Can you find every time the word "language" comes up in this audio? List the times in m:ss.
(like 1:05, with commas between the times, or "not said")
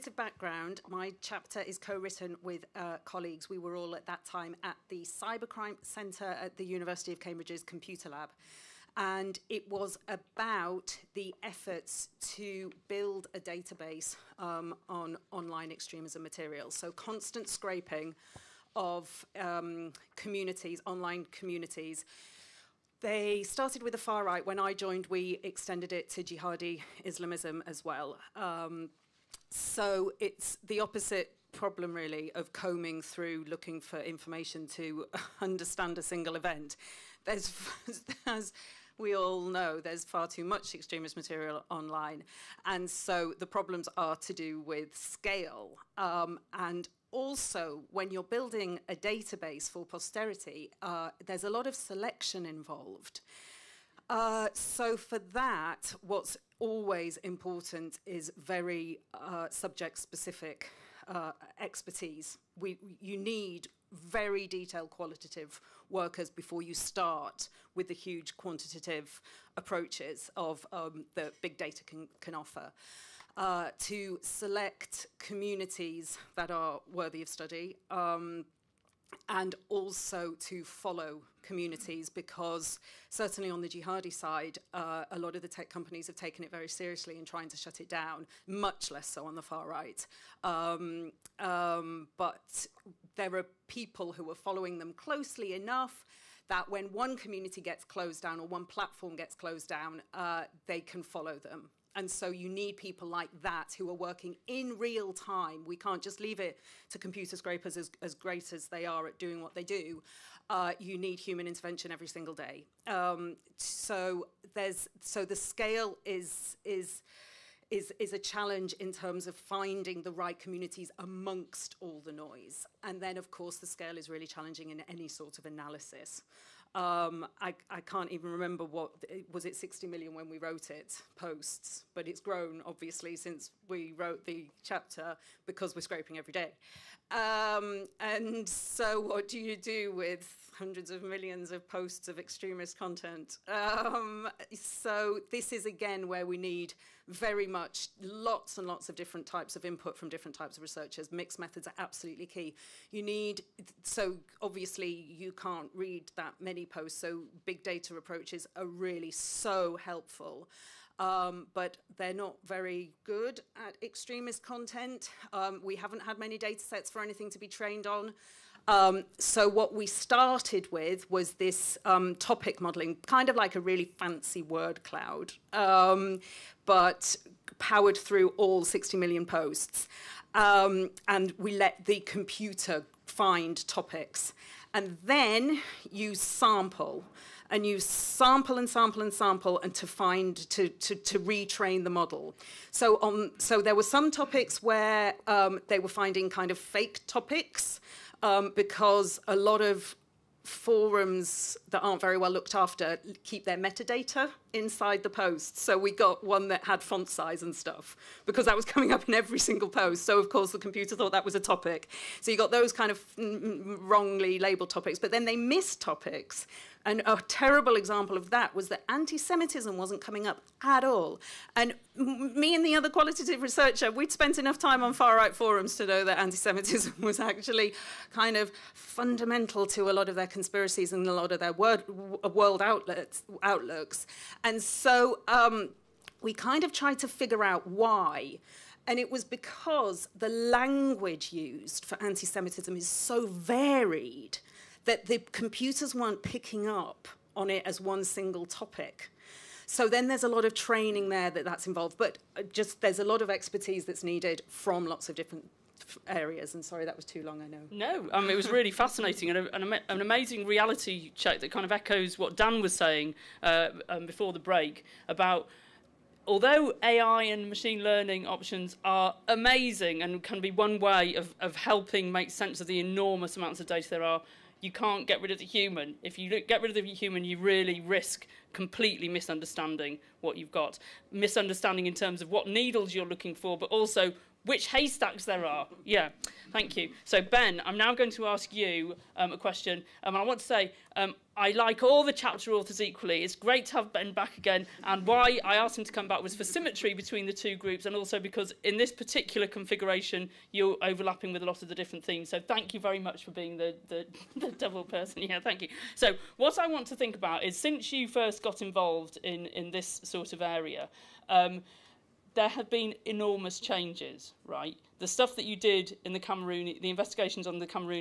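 4:00.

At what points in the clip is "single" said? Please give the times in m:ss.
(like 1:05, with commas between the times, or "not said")
0:36, 1:52, 3:29, 4:08.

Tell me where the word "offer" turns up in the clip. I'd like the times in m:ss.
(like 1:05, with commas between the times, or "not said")
1:12.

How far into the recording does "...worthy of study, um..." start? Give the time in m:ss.
1:16.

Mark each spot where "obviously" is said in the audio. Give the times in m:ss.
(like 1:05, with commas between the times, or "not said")
2:12, 2:34.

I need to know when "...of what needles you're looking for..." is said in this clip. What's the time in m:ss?
4:42.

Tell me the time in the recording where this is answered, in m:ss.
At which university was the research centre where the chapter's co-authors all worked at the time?
0:06.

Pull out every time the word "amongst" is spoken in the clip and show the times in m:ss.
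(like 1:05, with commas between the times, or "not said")
2:00.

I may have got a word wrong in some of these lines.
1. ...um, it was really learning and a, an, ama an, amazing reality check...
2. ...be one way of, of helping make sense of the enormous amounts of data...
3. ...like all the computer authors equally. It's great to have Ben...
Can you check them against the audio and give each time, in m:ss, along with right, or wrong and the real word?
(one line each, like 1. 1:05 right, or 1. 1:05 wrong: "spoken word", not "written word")
1. 4:18 wrong: "fascinating", not "learning"
2. 4:30 right
3. 4:51 wrong: "chapter", not "computer".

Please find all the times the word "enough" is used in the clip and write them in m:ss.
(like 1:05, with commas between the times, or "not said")
1:35, 3:44.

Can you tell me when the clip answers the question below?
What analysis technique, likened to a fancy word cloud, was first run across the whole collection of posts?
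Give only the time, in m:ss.
2:52.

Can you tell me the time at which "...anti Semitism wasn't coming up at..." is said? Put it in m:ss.
3:38.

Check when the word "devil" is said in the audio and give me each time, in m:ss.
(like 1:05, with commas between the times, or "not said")
5:04.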